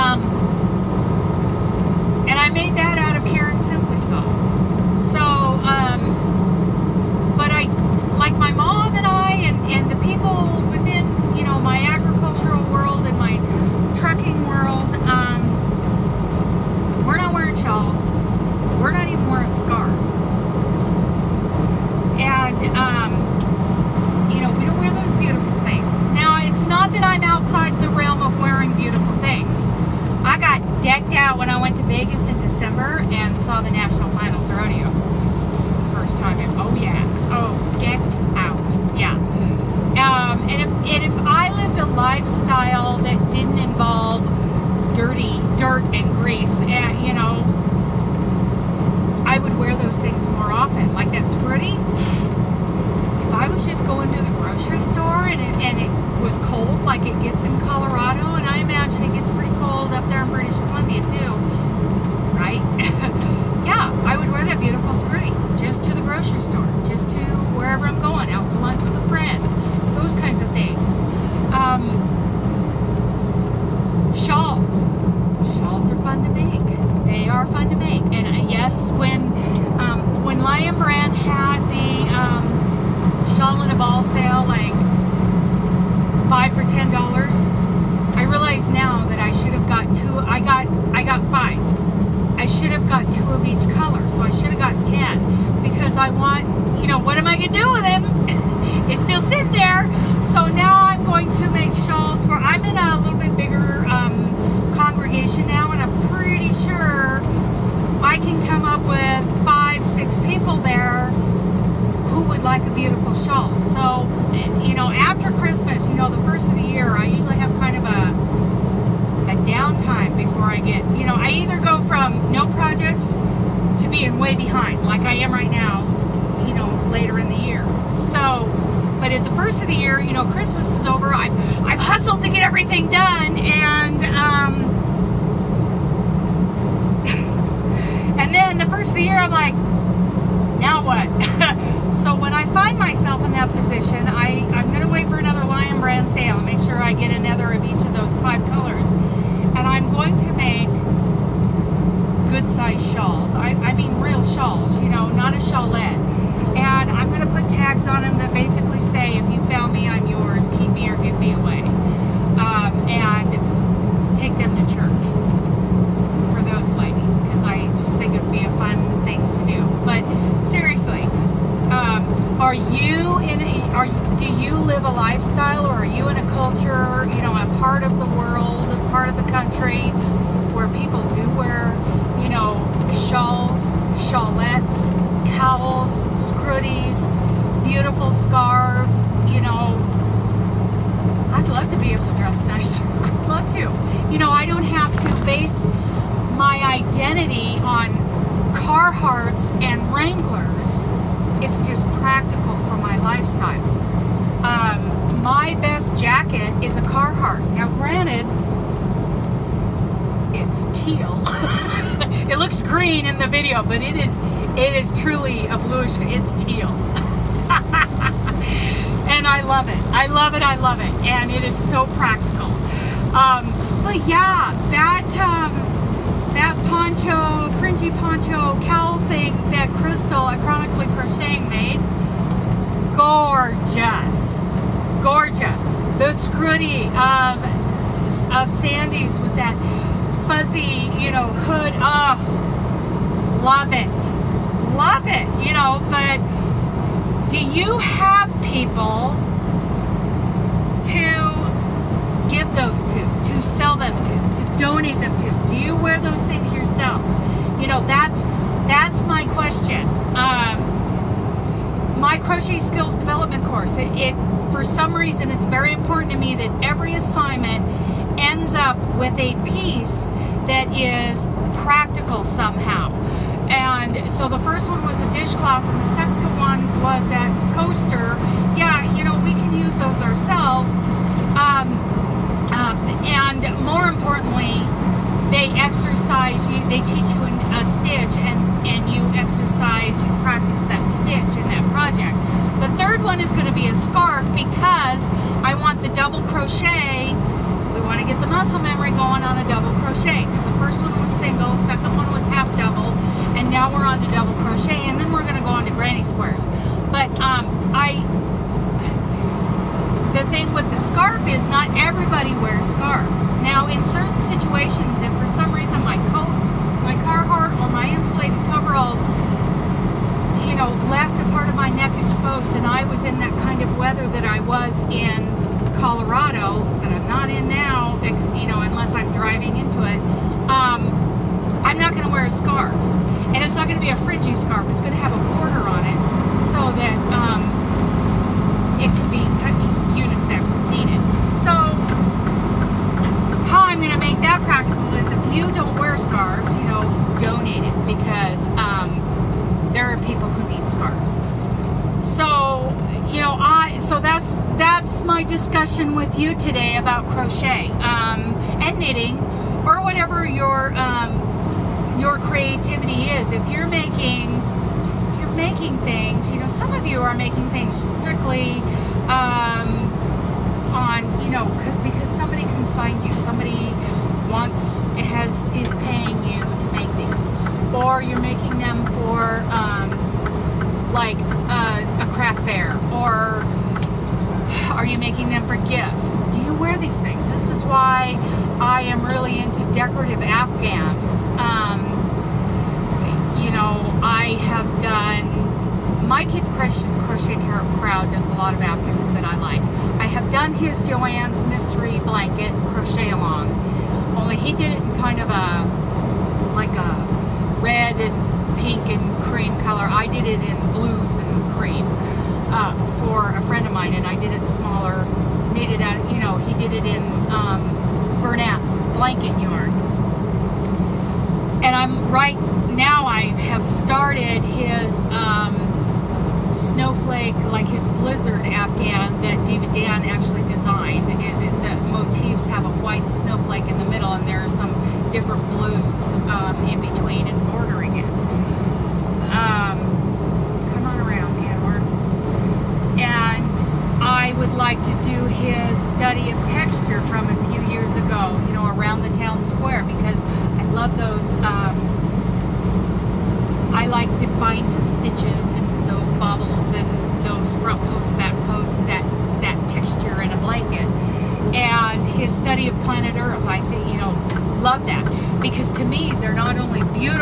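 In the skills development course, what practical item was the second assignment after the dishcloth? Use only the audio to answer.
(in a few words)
Coaster.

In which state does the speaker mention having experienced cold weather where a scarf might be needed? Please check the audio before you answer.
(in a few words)
Colorado.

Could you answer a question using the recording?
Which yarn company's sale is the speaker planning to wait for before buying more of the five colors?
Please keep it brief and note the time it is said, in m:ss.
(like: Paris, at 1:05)
Lion Brand, at 2:25.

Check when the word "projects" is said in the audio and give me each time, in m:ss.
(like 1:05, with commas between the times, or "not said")
2:02, 4:51.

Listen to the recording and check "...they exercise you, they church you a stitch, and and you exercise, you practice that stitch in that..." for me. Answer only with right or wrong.
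wrong.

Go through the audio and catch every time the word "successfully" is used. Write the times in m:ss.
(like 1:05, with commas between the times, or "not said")
not said.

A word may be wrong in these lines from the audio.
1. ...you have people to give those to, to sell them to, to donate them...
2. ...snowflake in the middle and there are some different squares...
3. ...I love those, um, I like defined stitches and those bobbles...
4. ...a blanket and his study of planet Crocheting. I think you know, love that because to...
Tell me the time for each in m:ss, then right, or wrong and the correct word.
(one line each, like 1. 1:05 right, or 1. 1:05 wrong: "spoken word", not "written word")
1. 4:07 right
2. 7:13 wrong: "blues", not "squares"
3. 7:30 right
4. 7:40 wrong: "Earth", not "Crocheting".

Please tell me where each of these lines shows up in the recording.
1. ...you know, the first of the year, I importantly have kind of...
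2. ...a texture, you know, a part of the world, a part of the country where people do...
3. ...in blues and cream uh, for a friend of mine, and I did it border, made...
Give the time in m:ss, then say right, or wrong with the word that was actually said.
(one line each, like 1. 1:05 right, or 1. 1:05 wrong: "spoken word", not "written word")
1. 1:55 wrong: "usually", not "importantly"
2. 2:56 wrong: "culture", not "texture"
3. 6:50 wrong: "smaller", not "border".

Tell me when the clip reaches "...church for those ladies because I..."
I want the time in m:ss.
2:44.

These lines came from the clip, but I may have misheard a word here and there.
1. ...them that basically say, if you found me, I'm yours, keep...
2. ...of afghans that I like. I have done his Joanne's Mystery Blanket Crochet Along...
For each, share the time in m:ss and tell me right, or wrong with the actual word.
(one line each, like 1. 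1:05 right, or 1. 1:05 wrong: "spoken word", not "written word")
1. 2:38 right
2. 6:38 right.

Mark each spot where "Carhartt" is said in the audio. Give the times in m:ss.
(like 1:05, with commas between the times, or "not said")
3:18, 3:26, 5:17.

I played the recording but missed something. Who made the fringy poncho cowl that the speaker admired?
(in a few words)
Chronically Crocheting.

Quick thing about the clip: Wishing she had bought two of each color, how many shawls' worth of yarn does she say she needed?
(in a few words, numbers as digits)
10.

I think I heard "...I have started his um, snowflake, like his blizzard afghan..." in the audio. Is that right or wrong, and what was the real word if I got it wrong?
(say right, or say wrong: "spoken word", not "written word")
right.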